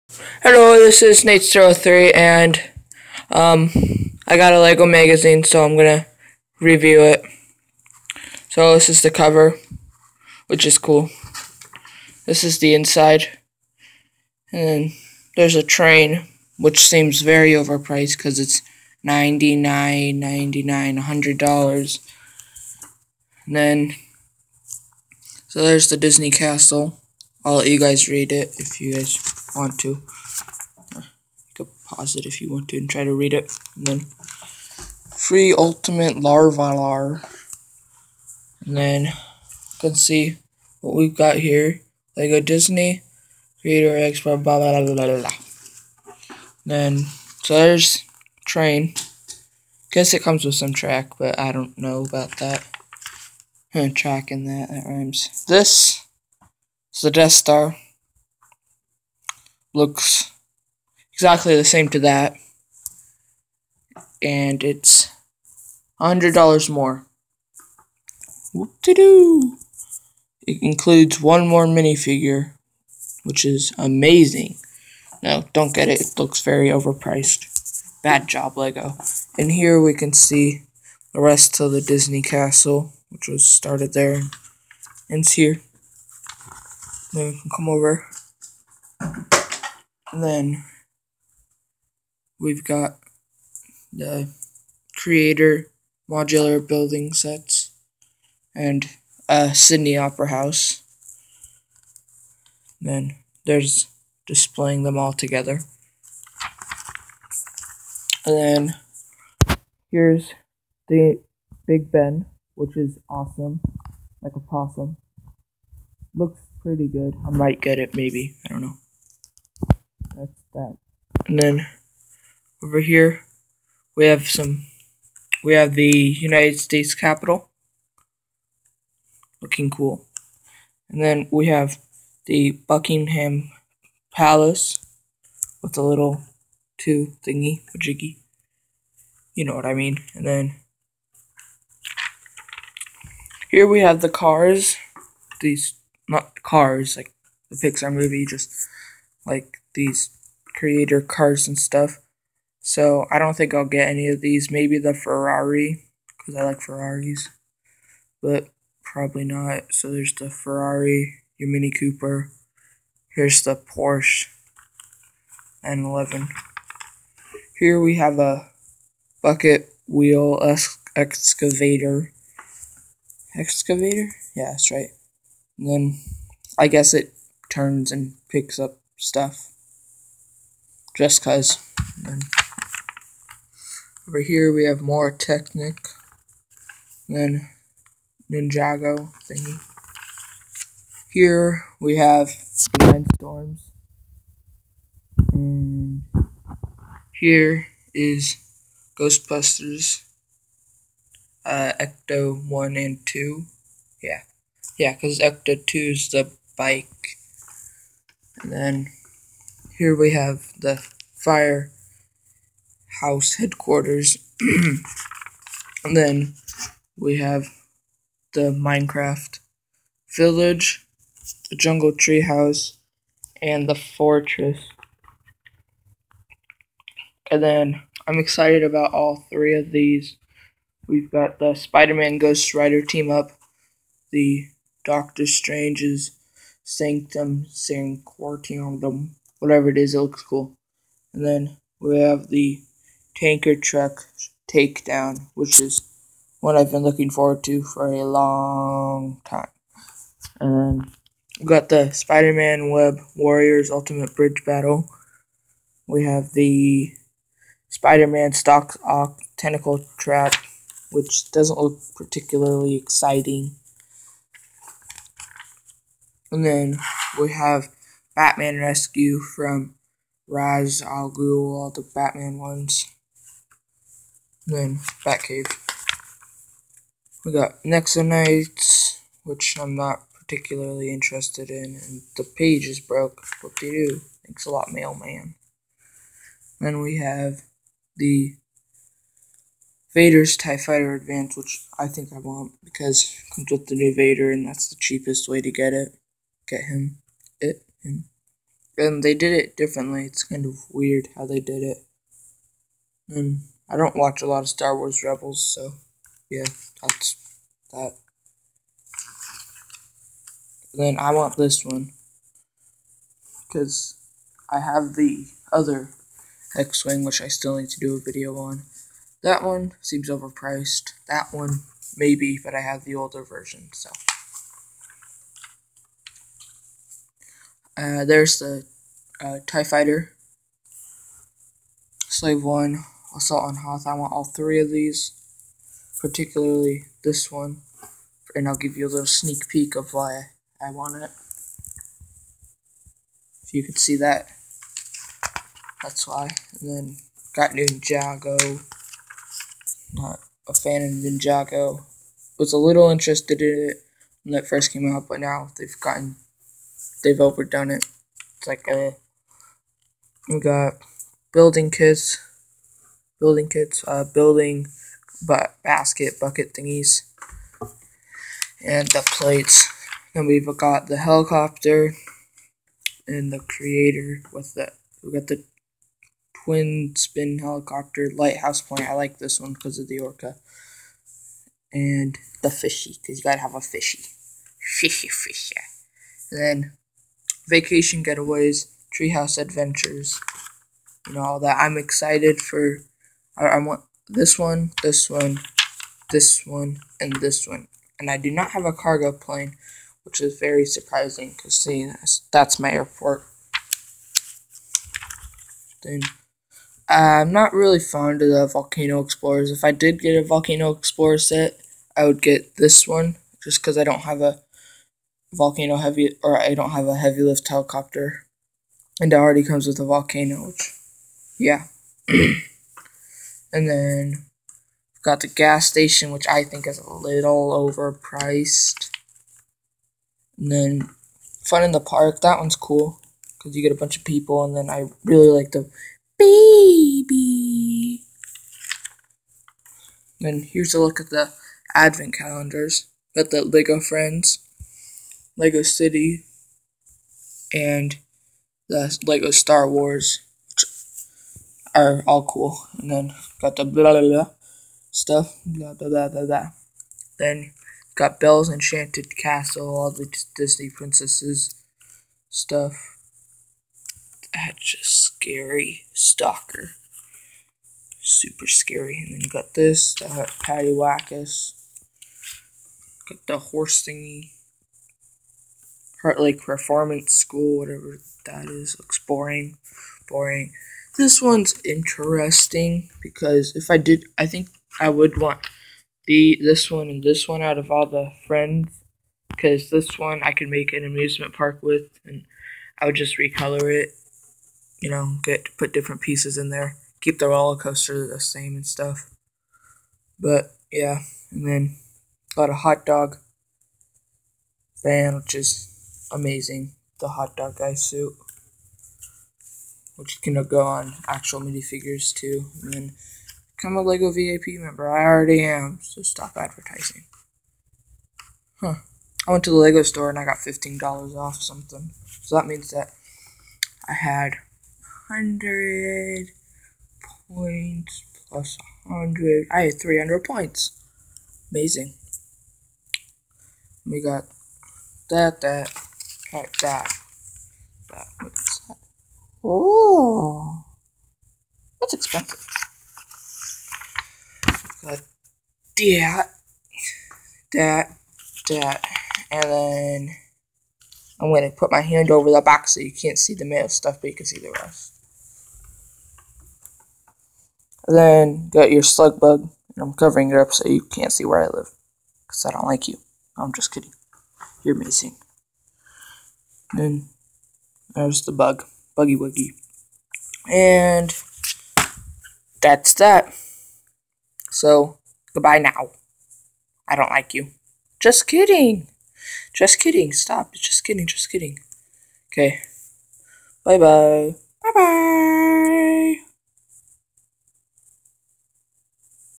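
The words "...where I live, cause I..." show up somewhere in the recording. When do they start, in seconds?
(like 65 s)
561 s.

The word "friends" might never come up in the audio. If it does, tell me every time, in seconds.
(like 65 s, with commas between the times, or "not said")
443 s, 488 s.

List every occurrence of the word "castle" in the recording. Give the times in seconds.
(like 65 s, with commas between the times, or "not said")
26 s, 82 s, 459 s.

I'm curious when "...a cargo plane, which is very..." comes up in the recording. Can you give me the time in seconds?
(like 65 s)
398 s.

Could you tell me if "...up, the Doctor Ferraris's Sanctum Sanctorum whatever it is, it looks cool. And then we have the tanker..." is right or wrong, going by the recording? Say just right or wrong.
wrong.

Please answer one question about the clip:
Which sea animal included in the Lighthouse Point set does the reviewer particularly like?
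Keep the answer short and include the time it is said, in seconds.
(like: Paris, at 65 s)
orca, at 379 s.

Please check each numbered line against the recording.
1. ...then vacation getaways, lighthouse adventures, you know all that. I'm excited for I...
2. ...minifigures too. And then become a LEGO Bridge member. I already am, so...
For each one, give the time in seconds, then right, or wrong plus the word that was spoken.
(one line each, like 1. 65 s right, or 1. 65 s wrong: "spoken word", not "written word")
1. 386 s wrong: "treehouse", not "lighthouse"
2. 511 s wrong: "VIP", not "Bridge".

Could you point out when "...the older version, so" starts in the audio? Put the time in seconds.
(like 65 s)
322 s.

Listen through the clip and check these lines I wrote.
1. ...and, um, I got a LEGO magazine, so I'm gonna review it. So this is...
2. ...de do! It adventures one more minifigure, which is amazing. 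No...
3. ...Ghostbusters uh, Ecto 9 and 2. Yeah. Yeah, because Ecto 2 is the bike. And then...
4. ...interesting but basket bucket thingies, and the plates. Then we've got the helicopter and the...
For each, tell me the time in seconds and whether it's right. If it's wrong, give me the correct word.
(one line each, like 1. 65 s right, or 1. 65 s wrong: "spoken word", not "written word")
1. 2 s right
2. 68 s wrong: "includes", not "adventures"
3. 198 s wrong: "1", not "9"
4. 364 s wrong: "building", not "interesting".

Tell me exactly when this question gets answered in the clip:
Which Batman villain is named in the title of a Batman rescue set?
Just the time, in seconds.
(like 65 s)
270 s.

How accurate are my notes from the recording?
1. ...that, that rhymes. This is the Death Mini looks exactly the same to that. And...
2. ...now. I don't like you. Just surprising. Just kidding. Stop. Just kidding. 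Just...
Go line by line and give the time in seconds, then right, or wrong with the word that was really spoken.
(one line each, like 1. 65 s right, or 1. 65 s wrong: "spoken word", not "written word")
1. 54 s wrong: "Star", not "Mini"
2. 575 s wrong: "kidding", not "surprising".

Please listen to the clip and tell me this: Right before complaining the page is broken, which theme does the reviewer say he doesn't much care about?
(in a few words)
Nexo Knights.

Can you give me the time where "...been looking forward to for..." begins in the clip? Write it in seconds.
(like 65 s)
246 s.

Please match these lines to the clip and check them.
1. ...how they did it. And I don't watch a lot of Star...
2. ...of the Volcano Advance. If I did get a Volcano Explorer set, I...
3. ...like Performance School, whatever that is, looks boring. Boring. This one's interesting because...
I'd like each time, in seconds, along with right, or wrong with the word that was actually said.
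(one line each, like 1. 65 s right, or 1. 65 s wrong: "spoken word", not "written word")
1. 301 s right
2. 408 s wrong: "Explorers", not "Advance"
3. 476 s right.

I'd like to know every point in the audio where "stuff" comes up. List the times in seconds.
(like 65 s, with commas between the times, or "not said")
151 s, 178 s, 454 s, 462 s, 498 s, 553 s.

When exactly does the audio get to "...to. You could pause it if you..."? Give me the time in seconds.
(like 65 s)
29 s.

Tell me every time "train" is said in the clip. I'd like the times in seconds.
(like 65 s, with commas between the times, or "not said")
15 s, 48 s.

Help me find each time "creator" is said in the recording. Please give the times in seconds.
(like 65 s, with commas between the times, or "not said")
43 s, 94 s, 150 s, 373 s.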